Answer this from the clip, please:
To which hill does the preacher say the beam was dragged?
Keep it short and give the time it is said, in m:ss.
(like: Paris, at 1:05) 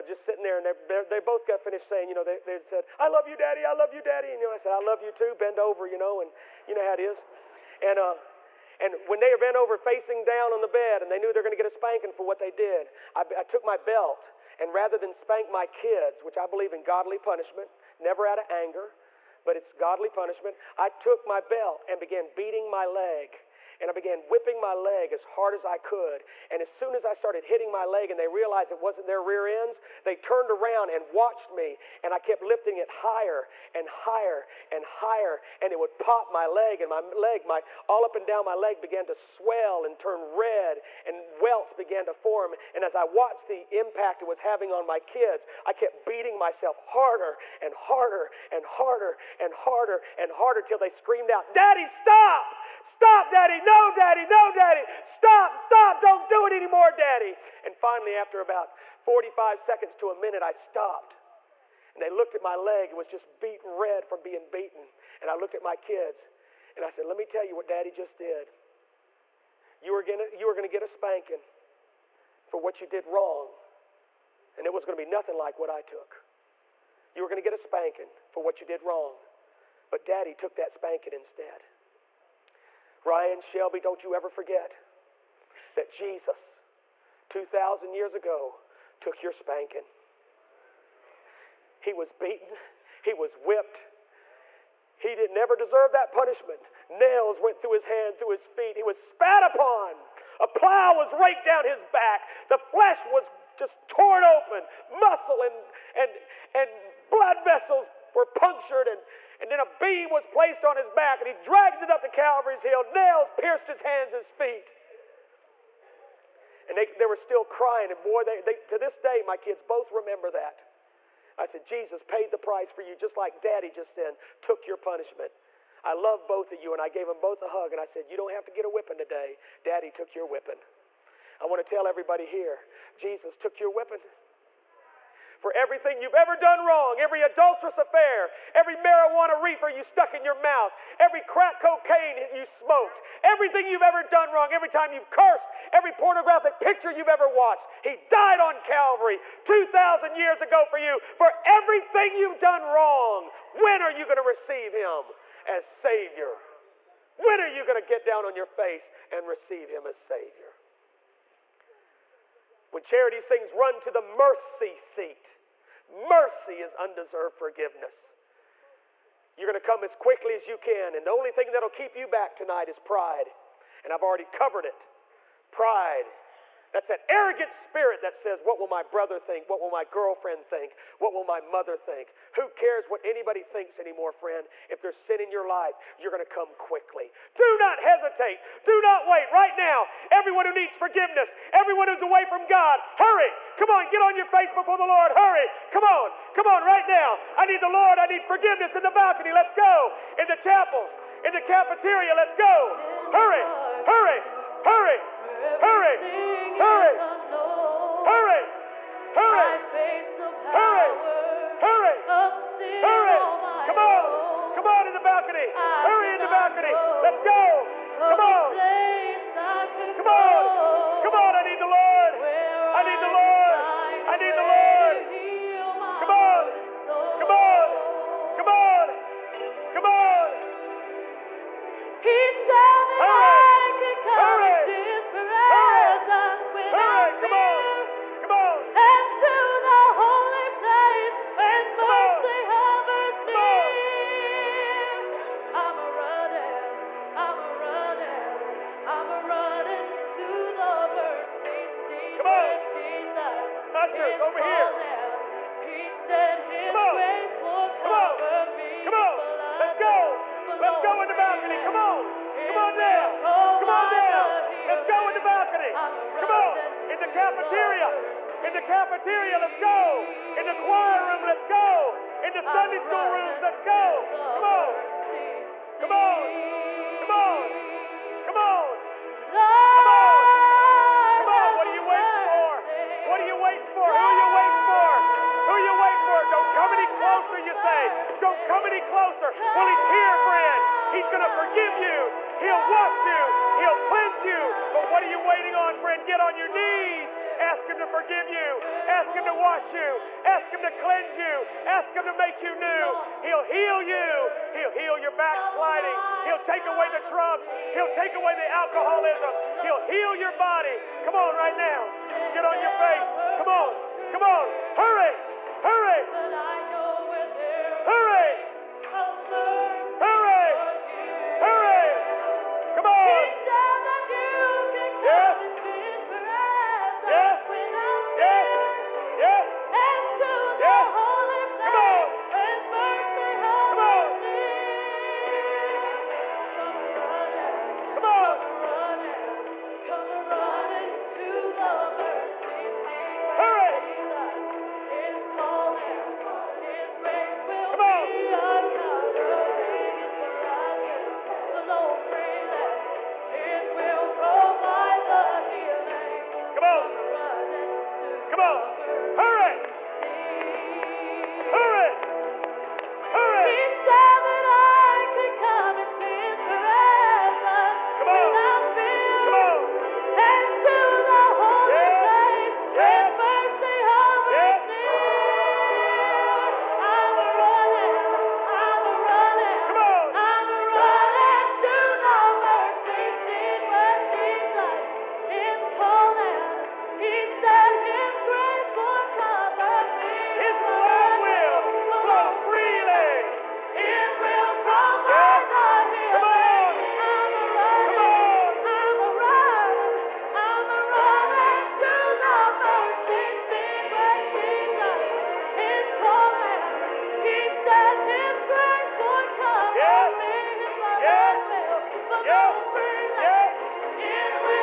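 Calvary's hill, at 1:52.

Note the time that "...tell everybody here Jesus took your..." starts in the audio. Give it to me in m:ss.
2:11.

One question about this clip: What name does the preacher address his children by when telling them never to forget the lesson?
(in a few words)
Ryan Shelby.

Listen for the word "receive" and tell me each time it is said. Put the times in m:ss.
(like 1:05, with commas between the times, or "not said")
2:34, 2:39.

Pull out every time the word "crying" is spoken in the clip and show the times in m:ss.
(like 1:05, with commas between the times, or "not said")
1:57.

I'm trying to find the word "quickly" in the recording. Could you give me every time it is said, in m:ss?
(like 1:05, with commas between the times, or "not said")
2:49, 3:06.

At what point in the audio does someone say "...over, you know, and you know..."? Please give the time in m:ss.
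0:05.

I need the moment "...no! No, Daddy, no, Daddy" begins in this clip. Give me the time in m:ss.
0:53.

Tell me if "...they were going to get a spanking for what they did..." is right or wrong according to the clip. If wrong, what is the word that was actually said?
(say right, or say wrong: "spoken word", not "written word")
right.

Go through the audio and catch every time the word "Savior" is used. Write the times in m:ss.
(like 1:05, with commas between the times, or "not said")
2:35, 2:39.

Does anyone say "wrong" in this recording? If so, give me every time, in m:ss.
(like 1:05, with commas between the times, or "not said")
1:13, 1:18, 2:16, 2:24, 2:32.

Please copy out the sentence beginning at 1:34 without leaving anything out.
He didn't ever deserve that punishment.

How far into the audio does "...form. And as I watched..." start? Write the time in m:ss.
0:42.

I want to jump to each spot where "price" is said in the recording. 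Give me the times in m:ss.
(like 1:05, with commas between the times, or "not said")
2:02.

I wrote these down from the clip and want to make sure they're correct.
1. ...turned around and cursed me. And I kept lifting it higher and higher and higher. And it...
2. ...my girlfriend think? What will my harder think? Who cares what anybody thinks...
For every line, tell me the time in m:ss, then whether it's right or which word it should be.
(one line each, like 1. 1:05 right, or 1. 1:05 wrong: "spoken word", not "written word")
1. 0:30 wrong: "watched", not "cursed"
2. 2:59 wrong: "mother", not "harder".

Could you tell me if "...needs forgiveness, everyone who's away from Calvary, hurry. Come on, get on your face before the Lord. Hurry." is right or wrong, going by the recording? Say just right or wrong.
wrong.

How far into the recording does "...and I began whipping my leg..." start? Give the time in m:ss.
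0:23.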